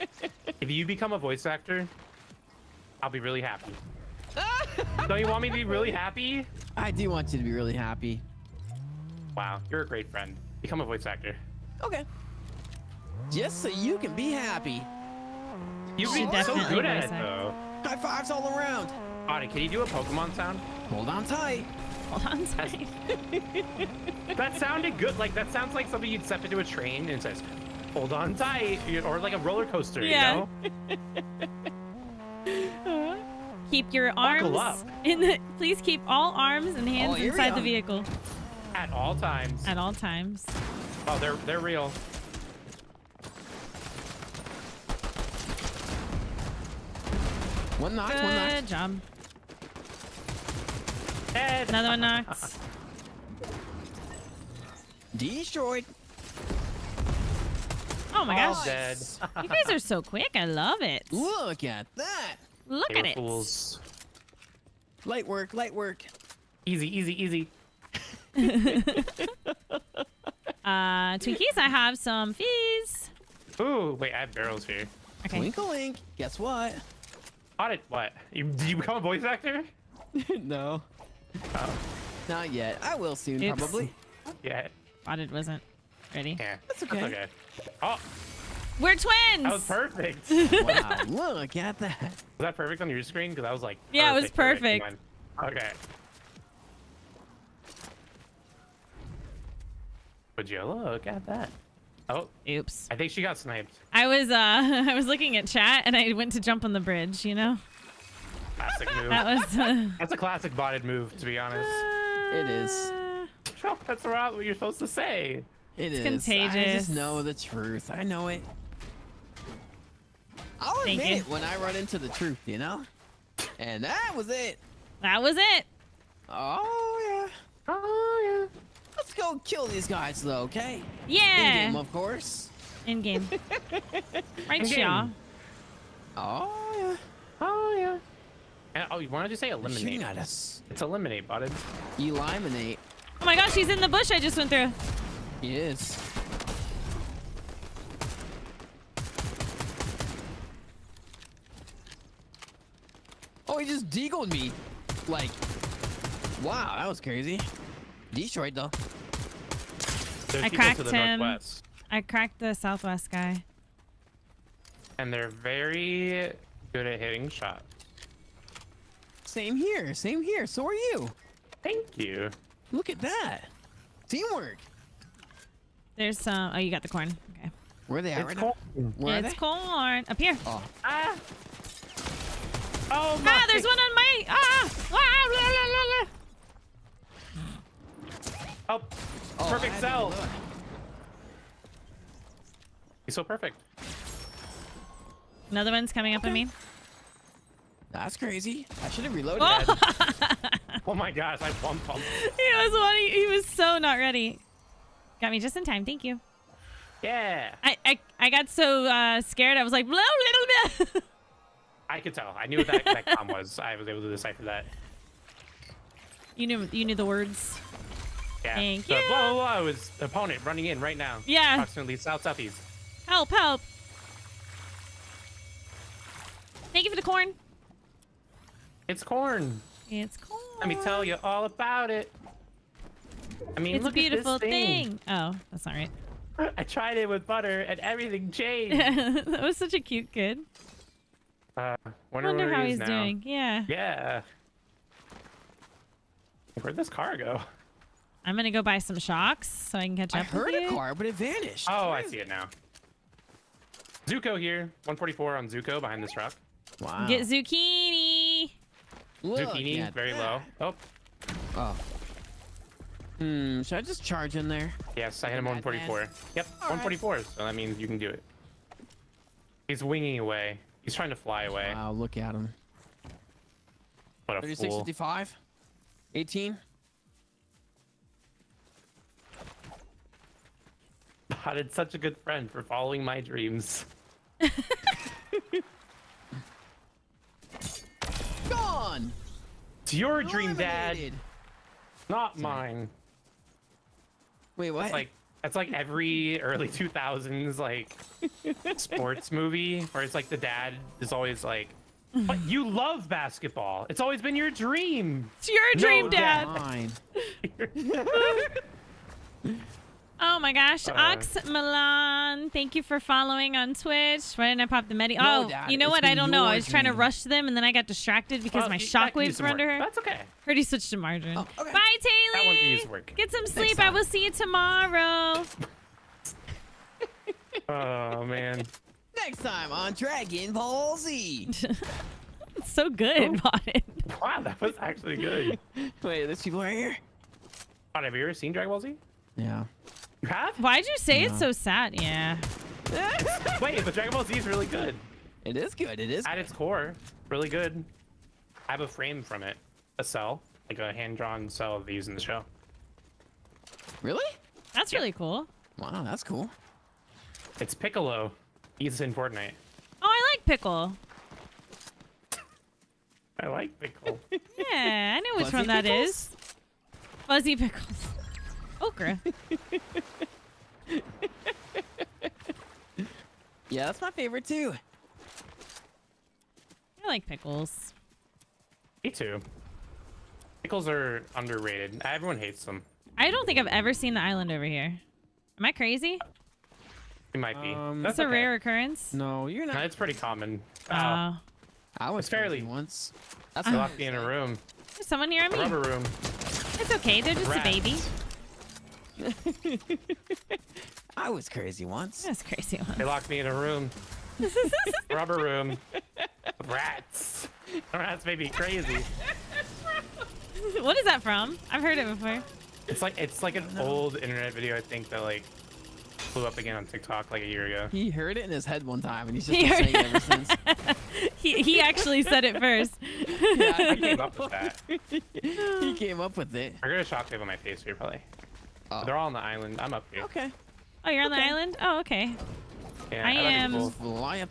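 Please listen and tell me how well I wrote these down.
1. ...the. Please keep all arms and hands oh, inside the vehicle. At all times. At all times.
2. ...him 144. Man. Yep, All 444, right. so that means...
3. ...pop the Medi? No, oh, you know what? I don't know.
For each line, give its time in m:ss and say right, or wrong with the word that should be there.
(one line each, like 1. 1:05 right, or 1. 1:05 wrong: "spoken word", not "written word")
1. 0:35 right
2. 4:25 wrong: "144", not "444"
3. 5:14 right.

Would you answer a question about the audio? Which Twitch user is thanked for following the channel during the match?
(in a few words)
Ox Milan.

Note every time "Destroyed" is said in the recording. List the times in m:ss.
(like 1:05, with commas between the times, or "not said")
0:55, 2:38.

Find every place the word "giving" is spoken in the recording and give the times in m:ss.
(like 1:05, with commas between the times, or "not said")
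not said.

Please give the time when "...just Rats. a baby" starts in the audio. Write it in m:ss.
6:37.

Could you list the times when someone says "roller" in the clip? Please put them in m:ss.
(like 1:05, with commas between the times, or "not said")
0:29.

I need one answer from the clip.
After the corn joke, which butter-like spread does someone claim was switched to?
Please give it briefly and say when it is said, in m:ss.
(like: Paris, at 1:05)
Margarine, at 5:20.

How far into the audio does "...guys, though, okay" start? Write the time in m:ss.
2:09.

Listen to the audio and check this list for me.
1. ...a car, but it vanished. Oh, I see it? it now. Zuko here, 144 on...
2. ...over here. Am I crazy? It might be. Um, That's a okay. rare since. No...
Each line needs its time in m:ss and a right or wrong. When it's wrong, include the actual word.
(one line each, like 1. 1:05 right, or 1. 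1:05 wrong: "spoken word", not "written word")
1. 4:10 right
2. 6:24 wrong: "occurrence", not "since".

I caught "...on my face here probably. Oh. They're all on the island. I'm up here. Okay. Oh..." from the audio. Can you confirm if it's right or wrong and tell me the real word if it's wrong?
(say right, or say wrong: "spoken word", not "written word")
right.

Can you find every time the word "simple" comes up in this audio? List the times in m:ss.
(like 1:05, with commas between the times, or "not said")
not said.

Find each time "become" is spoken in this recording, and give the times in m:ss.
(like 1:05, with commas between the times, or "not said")
0:00, 0:10, 1:18.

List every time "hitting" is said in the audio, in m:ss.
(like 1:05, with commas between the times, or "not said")
2:46.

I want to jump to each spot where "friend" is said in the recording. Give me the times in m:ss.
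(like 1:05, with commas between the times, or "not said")
0:10, 4:42.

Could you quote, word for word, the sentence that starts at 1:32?
Was that perfect on your screen?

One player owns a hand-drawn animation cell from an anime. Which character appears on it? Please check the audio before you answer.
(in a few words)
Piccolo.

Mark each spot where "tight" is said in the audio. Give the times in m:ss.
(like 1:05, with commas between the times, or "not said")
0:21, 0:28.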